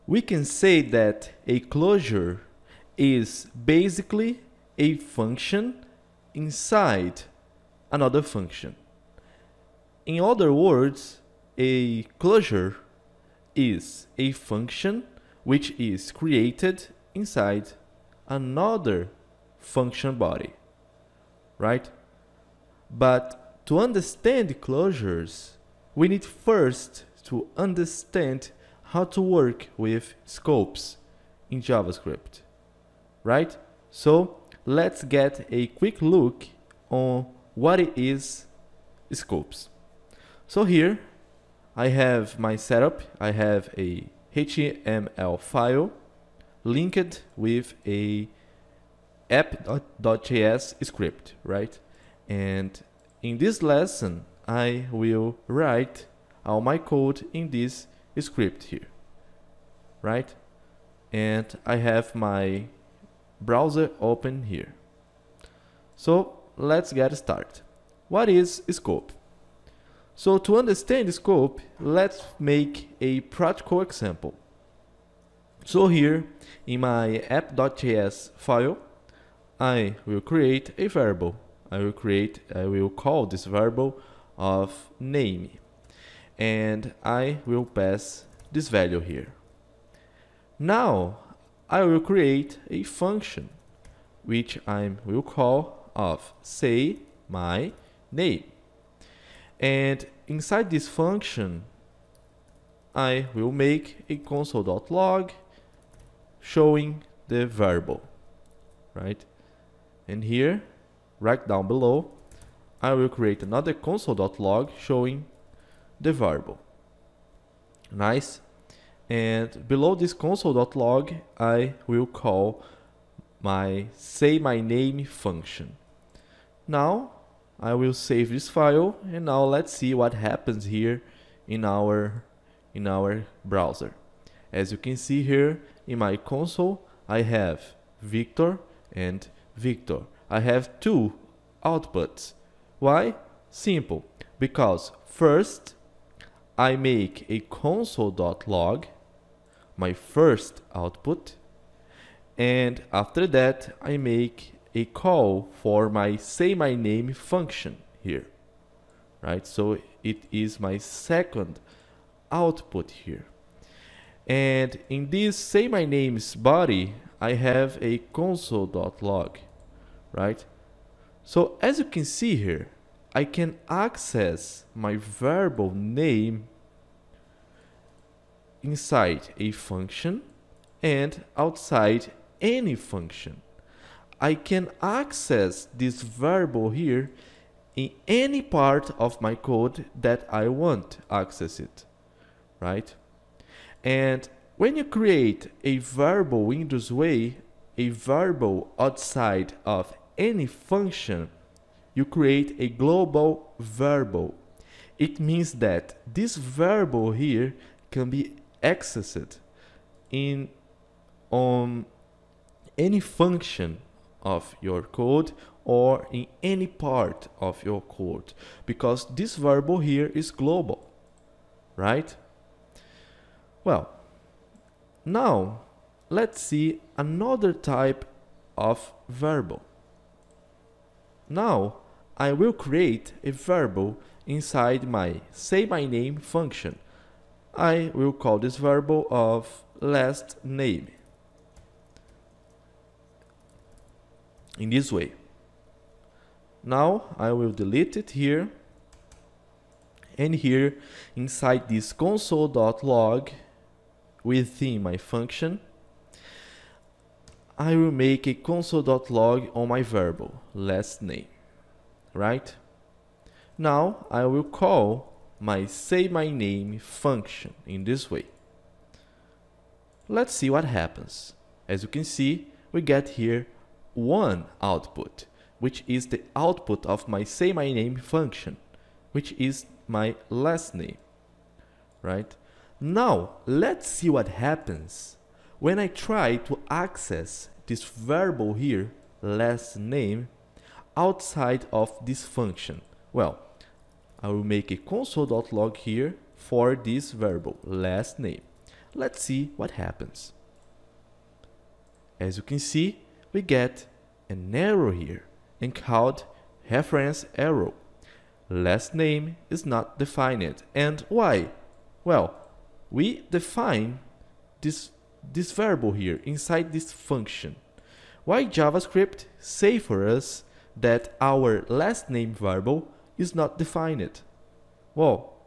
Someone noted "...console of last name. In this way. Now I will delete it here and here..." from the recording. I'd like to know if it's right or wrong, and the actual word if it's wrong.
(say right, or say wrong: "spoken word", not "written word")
wrong: "variable", not "console".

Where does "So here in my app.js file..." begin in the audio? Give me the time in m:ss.
1:15.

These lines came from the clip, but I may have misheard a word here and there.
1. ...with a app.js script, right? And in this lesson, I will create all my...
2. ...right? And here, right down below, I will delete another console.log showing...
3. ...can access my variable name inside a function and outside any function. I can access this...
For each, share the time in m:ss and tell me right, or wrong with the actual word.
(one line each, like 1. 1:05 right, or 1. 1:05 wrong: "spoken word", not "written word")
1. 0:47 wrong: "write", not "create"
2. 1:48 wrong: "create", not "delete"
3. 2:53 right.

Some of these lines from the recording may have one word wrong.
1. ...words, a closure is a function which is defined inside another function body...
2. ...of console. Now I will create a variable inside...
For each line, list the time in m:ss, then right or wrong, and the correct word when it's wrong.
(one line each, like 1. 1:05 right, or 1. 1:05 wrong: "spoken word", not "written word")
1. 0:10 wrong: "created", not "defined"
2. 3:48 wrong: "variable", not "console".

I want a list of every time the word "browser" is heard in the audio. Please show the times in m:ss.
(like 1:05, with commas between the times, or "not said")
1:03, 2:13.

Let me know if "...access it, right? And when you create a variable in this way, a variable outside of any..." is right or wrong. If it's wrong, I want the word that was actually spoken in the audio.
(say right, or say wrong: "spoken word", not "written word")
right.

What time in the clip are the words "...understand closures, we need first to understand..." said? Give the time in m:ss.
0:23.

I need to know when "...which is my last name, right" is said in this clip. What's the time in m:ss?
4:39.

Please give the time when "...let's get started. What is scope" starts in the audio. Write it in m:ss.
1:06.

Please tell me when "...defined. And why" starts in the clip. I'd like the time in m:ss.
5:09.